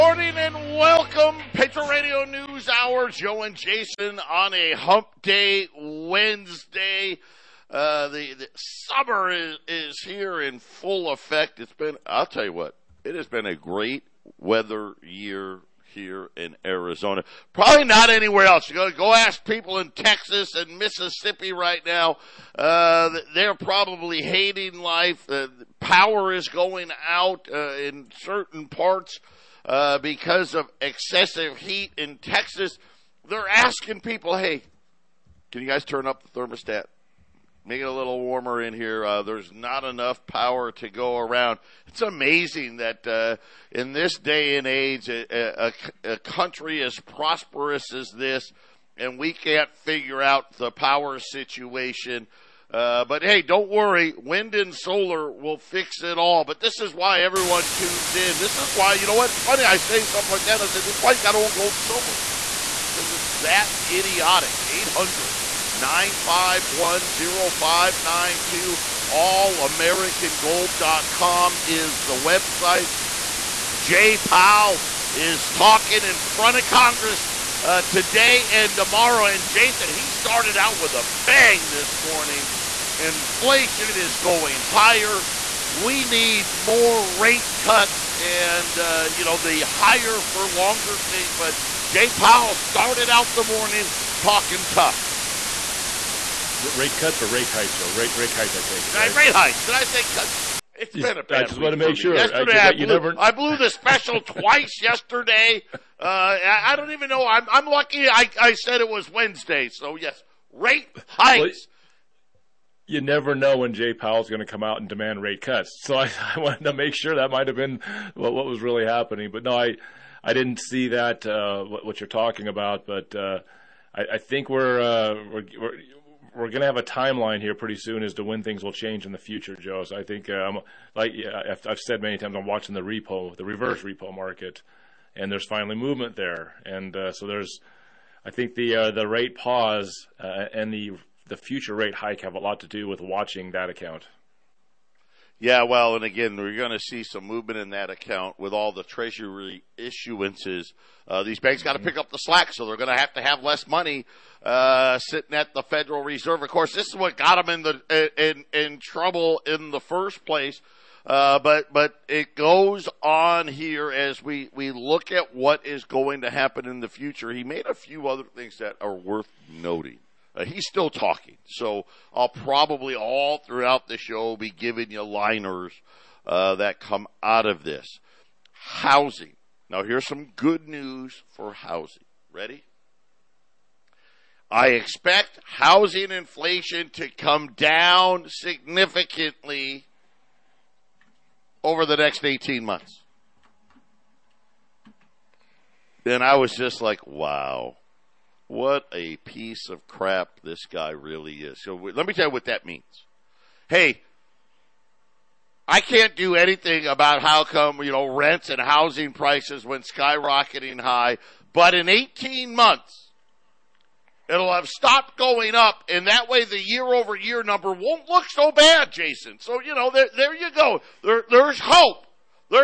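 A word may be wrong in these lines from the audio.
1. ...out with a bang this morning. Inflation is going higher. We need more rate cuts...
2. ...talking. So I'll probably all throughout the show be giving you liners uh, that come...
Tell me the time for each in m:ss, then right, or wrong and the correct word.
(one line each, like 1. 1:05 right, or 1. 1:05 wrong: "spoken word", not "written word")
1. 1:20 right
2. 2:50 right.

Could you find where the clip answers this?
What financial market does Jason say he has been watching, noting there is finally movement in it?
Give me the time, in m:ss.
2:13.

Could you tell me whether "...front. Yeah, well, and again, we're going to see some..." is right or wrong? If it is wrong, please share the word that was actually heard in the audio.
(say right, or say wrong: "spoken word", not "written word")
wrong: "account", not "front".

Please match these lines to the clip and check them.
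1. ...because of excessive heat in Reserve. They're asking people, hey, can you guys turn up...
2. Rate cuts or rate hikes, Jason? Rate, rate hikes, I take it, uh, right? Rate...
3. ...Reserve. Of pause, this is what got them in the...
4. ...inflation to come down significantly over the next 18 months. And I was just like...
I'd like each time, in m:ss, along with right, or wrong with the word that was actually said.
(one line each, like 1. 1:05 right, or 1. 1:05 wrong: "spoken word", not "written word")
1. 0:29 wrong: "Texas", not "Reserve"
2. 1:36 wrong: "Joe", not "Jason"
3. 2:36 wrong: "course", not "pause"
4. 3:06 right.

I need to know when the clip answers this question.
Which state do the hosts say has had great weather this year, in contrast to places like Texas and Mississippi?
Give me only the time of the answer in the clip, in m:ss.
0:16.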